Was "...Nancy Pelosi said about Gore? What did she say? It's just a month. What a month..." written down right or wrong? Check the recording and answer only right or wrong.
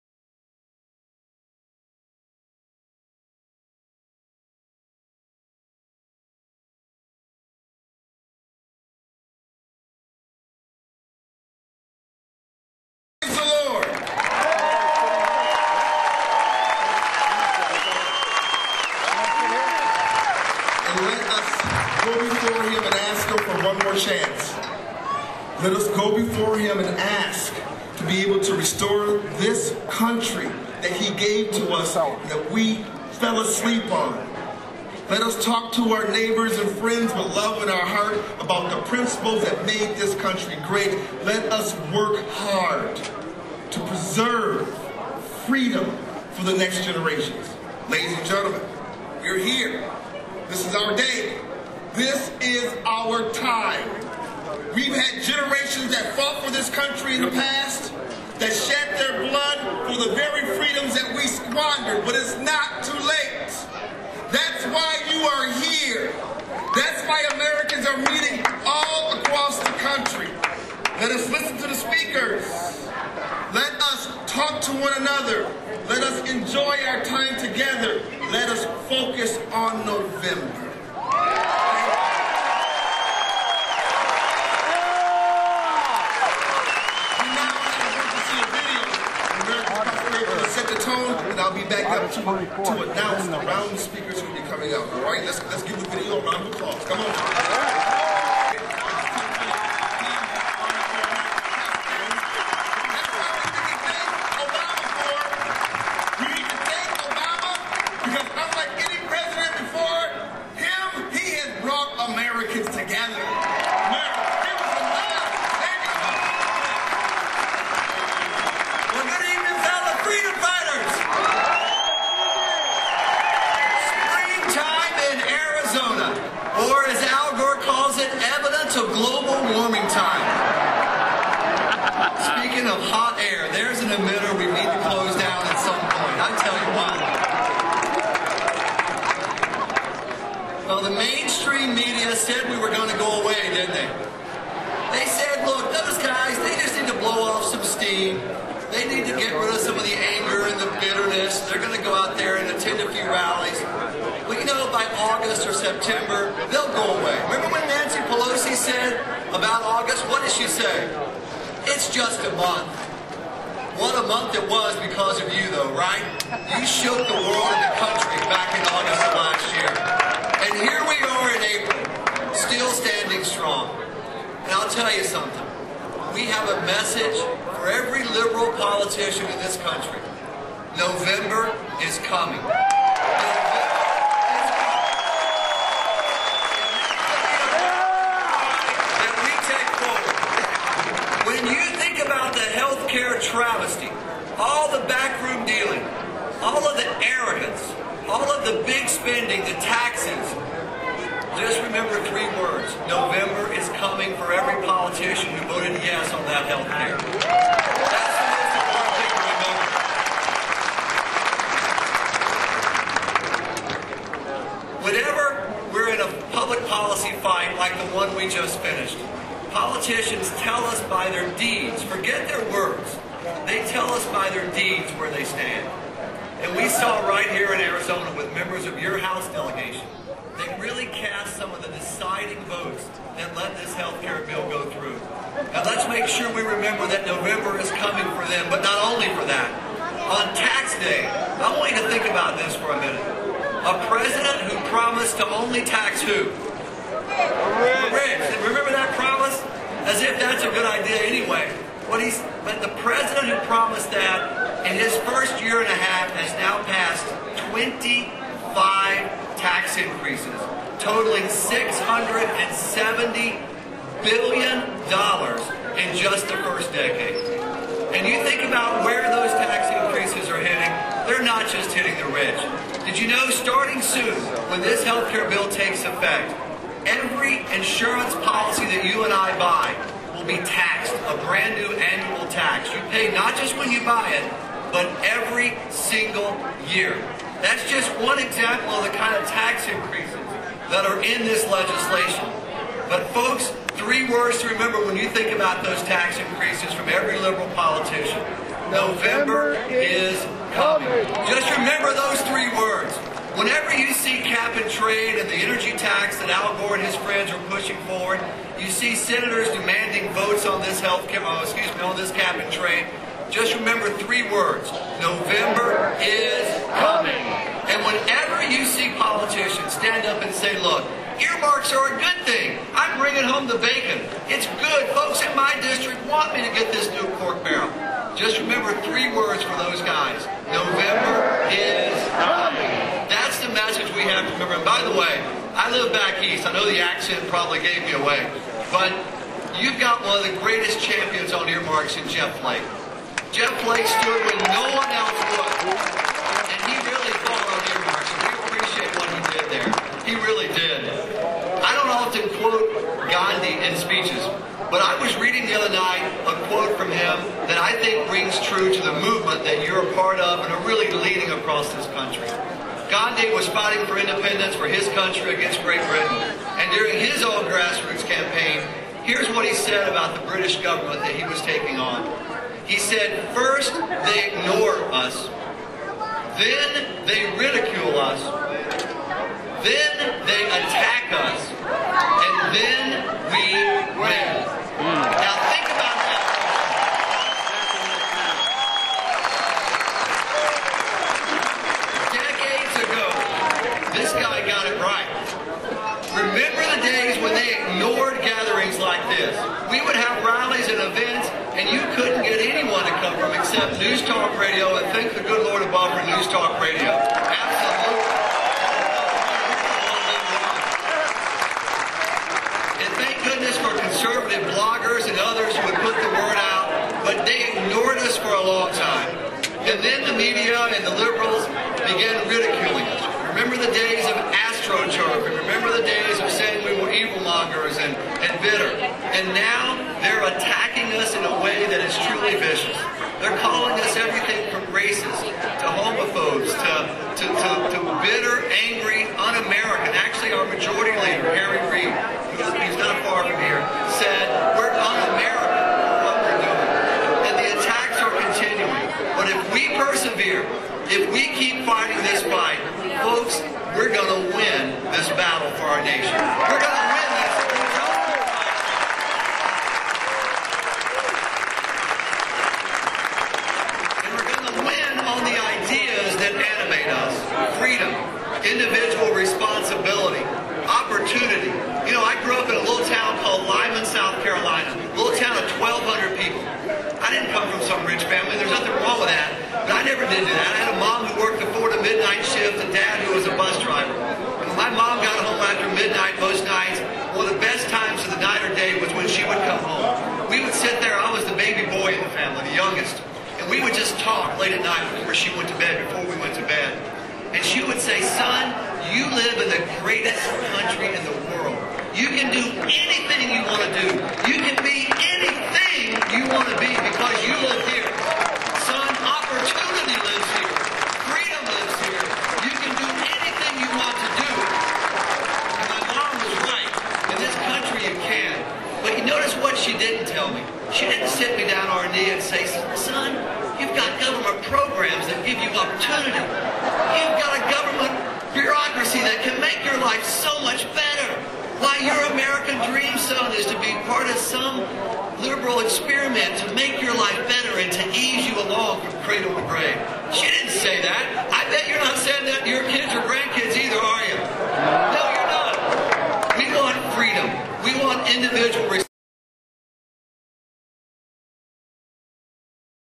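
wrong.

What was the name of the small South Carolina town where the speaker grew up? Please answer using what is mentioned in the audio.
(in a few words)
Lyman.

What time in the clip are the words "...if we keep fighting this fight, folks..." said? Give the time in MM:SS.
07:30.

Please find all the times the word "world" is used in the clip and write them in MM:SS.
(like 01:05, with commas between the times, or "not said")
02:47, 08:21.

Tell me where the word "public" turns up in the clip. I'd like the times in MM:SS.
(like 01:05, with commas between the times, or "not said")
03:36.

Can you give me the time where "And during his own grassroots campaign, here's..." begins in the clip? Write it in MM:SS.
06:06.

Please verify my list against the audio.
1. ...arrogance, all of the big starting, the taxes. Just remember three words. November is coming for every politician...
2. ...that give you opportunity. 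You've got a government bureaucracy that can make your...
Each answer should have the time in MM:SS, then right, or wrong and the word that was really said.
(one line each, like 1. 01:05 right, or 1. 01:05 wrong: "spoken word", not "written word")
1. 03:17 wrong: "spending", not "starting"
2. 08:45 right.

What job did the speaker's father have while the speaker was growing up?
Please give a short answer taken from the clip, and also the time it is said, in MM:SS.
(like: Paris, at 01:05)
bus driver, at 08:03.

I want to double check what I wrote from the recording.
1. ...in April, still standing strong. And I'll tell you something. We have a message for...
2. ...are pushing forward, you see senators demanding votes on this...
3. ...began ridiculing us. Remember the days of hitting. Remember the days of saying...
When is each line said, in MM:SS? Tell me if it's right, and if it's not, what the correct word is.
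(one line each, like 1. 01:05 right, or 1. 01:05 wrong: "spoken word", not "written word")
1. 02:51 right
2. 05:07 right
3. 07:01 wrong: "astroturfing", not "hitting".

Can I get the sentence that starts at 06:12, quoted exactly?
He said, first, they ignore us.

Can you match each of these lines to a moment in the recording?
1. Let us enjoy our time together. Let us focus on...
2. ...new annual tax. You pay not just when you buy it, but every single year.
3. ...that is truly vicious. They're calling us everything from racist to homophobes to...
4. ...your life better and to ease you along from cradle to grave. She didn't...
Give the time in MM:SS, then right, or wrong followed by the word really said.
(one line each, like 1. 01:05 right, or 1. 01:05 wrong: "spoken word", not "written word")
1. 01:15 right
2. 04:41 right
3. 07:11 right
4. 08:56 right.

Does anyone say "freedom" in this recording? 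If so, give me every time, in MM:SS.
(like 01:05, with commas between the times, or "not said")
00:45, 01:00, 08:31, 09:06.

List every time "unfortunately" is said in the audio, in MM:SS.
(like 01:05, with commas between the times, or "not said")
not said.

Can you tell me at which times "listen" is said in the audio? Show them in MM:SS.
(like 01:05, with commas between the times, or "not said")
01:11.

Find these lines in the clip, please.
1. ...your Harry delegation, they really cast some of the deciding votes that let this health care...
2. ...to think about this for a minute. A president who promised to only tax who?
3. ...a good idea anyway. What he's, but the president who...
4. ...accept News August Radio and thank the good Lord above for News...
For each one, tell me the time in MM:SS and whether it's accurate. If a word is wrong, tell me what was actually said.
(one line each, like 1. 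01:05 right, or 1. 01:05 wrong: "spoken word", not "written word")
1. 03:48 wrong: "House", not "Harry"
2. 04:01 right
3. 04:10 right
4. 06:43 wrong: "Talk", not "August".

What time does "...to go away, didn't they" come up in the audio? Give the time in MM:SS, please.
02:22.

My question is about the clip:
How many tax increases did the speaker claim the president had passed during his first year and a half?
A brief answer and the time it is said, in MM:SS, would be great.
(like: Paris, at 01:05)
25, at 04:17.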